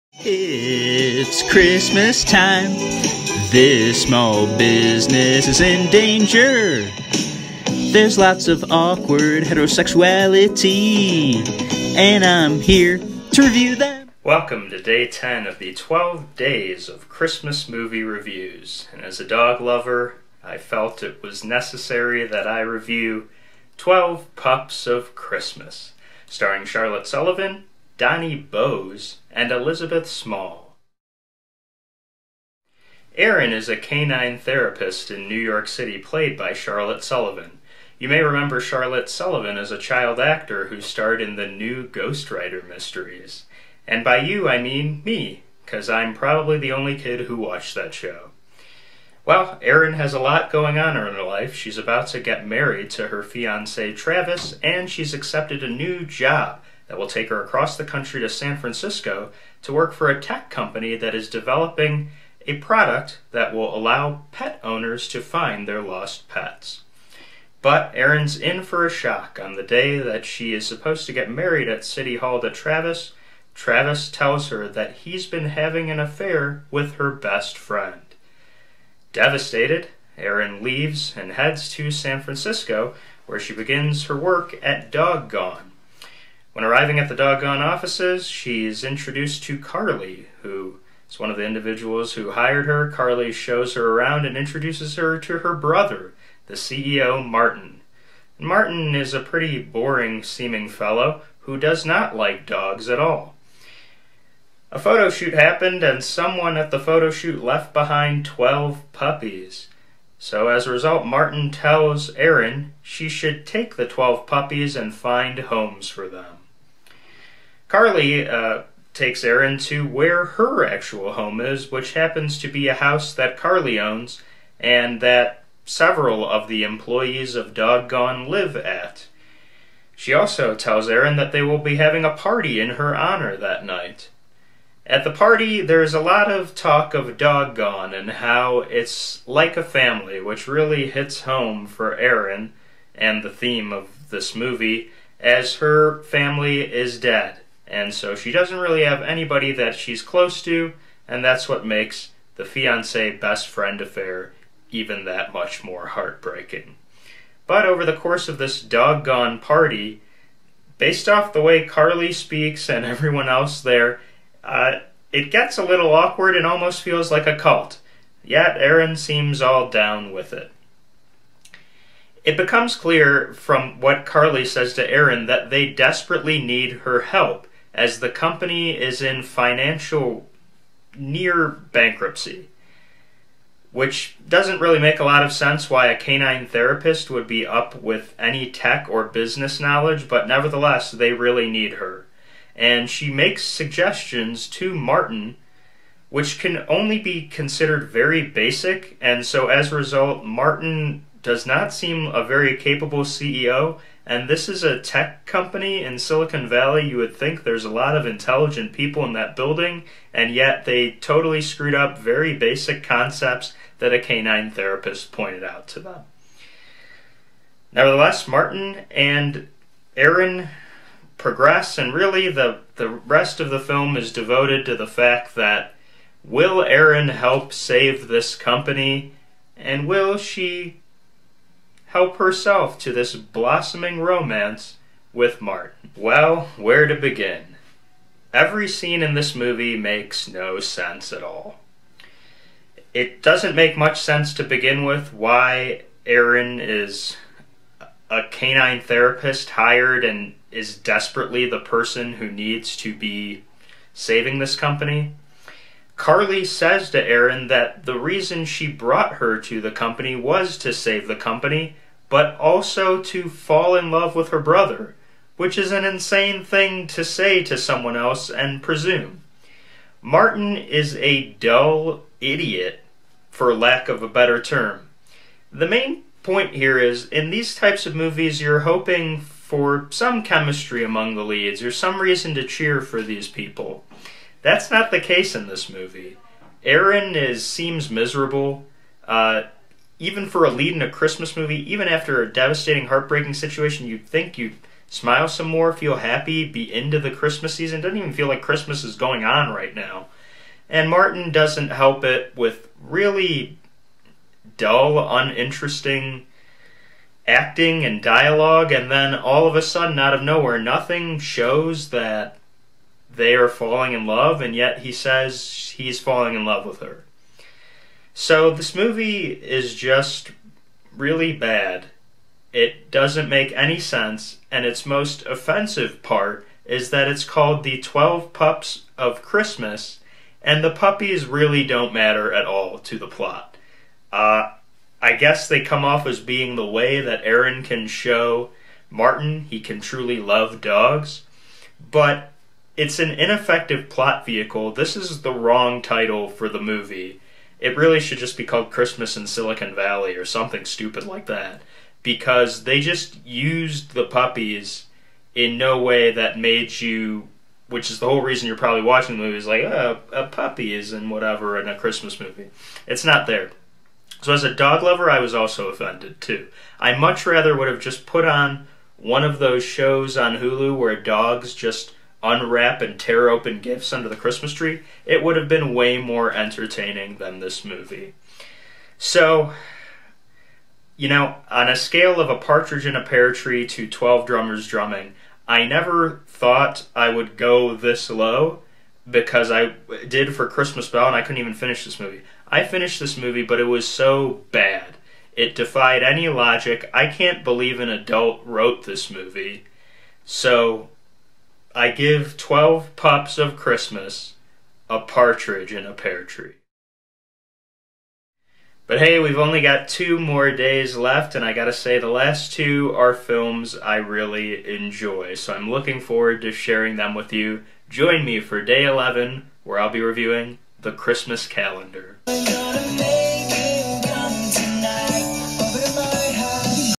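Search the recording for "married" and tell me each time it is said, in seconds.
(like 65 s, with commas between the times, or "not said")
52 s, 71 s.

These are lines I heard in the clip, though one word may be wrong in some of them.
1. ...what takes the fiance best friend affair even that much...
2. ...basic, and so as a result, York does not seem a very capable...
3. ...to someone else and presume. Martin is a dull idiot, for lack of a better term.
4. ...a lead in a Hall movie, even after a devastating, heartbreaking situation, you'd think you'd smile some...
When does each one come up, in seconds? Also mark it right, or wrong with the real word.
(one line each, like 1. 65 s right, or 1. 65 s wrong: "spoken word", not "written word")
1. 151 s wrong: "makes", not "takes"
2. 198 s wrong: "Martin", not "York"
3. 267 s right
4. 290 s wrong: "Christmas", not "Hall".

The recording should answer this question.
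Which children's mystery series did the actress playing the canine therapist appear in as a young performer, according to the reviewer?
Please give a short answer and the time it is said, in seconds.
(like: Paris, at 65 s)
Ghostwriter, at 41 s.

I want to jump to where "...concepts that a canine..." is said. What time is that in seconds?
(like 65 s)
212 s.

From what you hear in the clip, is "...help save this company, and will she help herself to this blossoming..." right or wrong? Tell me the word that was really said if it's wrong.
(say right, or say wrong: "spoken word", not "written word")
right.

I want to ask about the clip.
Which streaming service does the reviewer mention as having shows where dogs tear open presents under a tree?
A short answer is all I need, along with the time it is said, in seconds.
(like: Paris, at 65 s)
Hulu, at 370 s.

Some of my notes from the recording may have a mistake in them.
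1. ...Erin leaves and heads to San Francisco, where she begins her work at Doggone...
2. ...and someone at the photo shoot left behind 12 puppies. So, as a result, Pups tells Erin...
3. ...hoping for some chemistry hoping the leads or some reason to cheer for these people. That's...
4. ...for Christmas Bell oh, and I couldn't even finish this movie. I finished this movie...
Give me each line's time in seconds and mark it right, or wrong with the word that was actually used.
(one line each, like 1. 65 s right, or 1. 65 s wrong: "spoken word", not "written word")
1. 80 s right
2. 105 s wrong: "Martin", not "Pups"
3. 278 s wrong: "among", not "hoping"
4. 390 s right.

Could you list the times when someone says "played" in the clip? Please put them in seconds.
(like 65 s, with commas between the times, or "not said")
35 s.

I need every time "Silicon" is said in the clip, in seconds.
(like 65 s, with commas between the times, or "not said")
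205 s, 349 s.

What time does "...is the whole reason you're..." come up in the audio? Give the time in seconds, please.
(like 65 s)
357 s.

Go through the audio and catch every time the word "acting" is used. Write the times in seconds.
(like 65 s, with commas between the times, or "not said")
307 s.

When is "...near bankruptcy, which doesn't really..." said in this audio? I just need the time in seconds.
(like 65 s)
180 s.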